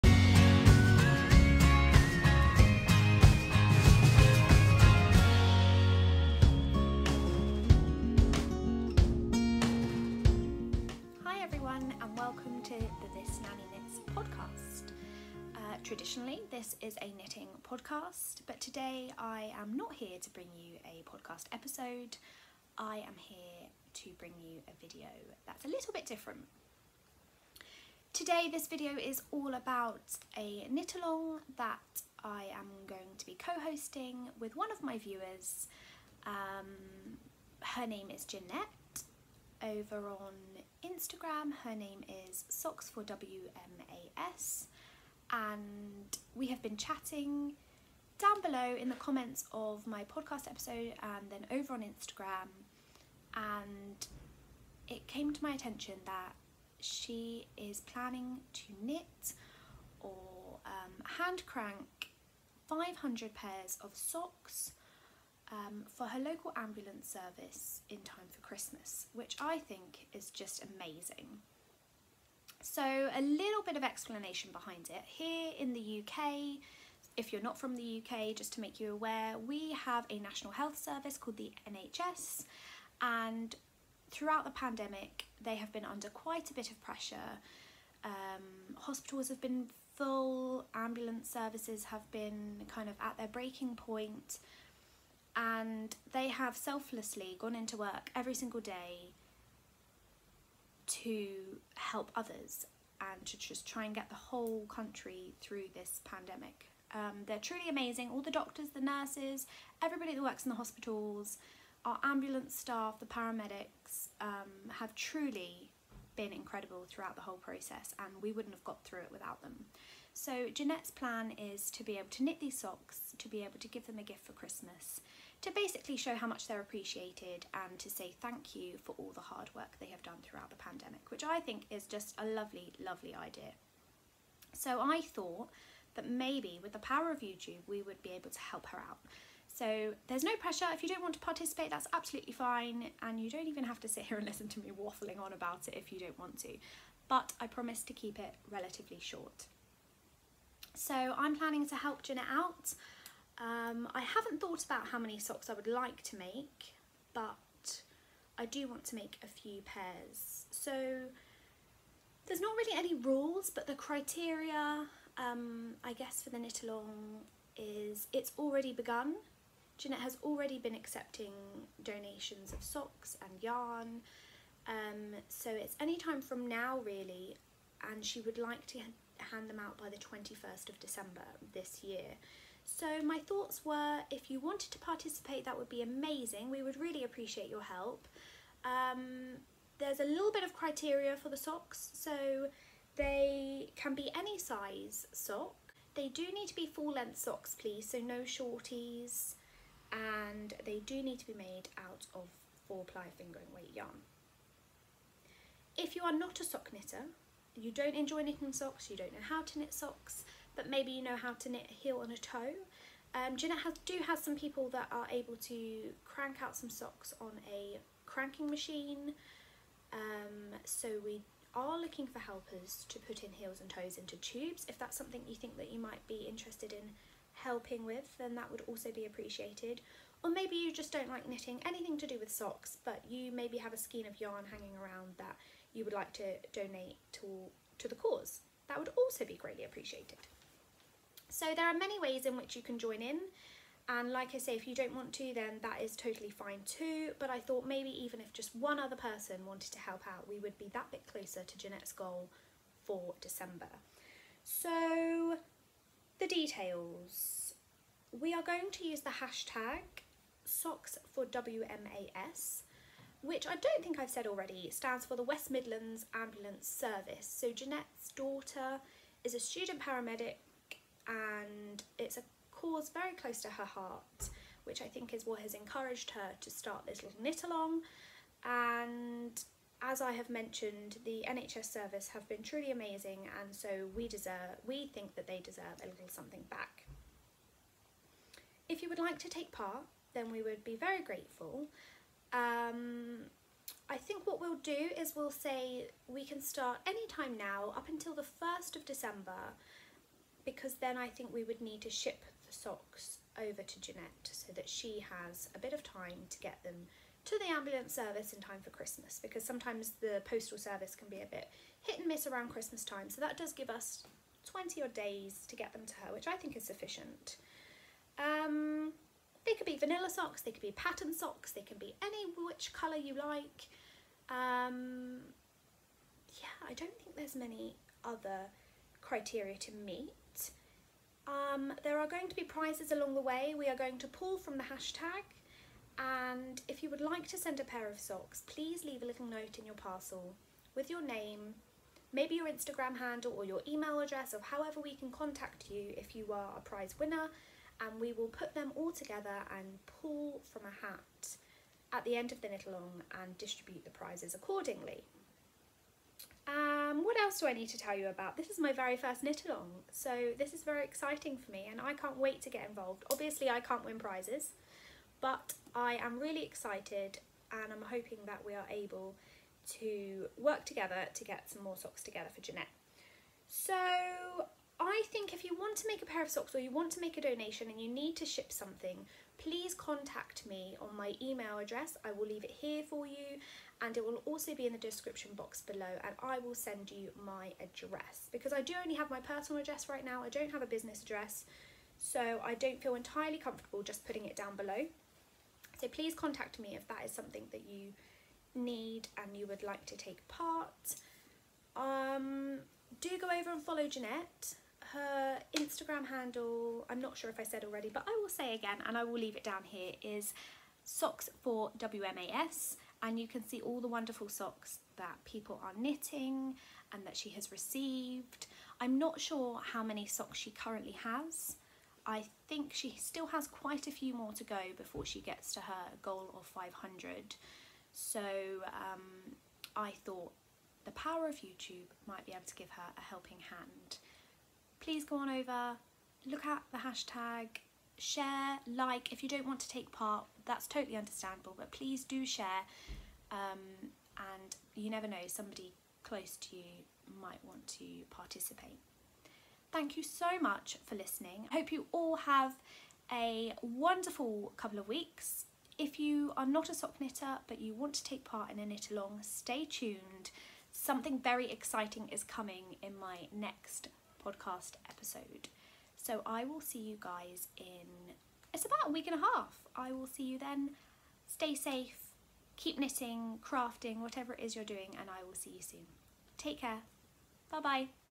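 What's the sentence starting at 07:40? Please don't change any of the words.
Something very exciting is coming in my next podcast episode.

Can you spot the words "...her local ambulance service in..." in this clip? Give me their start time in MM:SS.
01:06.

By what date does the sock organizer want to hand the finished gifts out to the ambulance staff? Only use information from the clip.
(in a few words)
21st of December.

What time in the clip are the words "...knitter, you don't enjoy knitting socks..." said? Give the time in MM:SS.
03:26.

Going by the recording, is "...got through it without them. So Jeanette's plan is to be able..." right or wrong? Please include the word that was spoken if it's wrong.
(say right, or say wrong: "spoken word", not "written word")
right.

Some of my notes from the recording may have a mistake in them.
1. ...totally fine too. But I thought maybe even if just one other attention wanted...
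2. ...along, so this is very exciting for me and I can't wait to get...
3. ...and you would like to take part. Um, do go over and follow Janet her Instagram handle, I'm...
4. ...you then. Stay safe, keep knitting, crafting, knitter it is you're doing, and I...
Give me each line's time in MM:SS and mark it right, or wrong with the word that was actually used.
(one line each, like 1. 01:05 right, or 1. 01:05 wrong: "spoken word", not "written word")
1. 04:05 wrong: "person", not "attention"
2. 05:59 right
3. 06:39 wrong: "Jeanette", not "Janet"
4. 07:50 wrong: "whatever", not "knitter".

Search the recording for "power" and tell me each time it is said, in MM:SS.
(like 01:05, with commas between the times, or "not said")
02:16, 07:10.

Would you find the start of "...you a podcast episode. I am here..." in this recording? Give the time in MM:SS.
00:20.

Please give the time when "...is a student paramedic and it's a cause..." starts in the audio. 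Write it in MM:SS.
04:29.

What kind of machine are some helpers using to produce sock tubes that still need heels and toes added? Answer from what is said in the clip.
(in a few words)
Cranking machine.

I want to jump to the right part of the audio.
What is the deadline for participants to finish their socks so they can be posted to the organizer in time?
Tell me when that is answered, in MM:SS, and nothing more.
04:58.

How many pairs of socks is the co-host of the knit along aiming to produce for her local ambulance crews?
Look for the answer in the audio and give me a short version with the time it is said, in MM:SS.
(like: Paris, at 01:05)
500, at 01:02.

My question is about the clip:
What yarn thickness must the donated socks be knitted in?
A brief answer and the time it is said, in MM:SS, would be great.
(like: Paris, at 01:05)
Four ply fingering weight, at 03:22.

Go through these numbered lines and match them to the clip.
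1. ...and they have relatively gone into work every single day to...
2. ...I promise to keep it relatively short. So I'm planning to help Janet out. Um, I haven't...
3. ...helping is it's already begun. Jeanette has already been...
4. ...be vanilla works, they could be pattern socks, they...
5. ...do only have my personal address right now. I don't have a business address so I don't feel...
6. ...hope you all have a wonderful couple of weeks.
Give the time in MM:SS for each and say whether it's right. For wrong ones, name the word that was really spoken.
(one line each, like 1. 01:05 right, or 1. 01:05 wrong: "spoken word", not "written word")
1. 01:35 wrong: "selflessly", not "relatively"
2. 02:27 right
3. 02:46 wrong: "along", not "helping"
4. 05:19 wrong: "socks", not "works"
5. 06:28 right
6. 07:31 right.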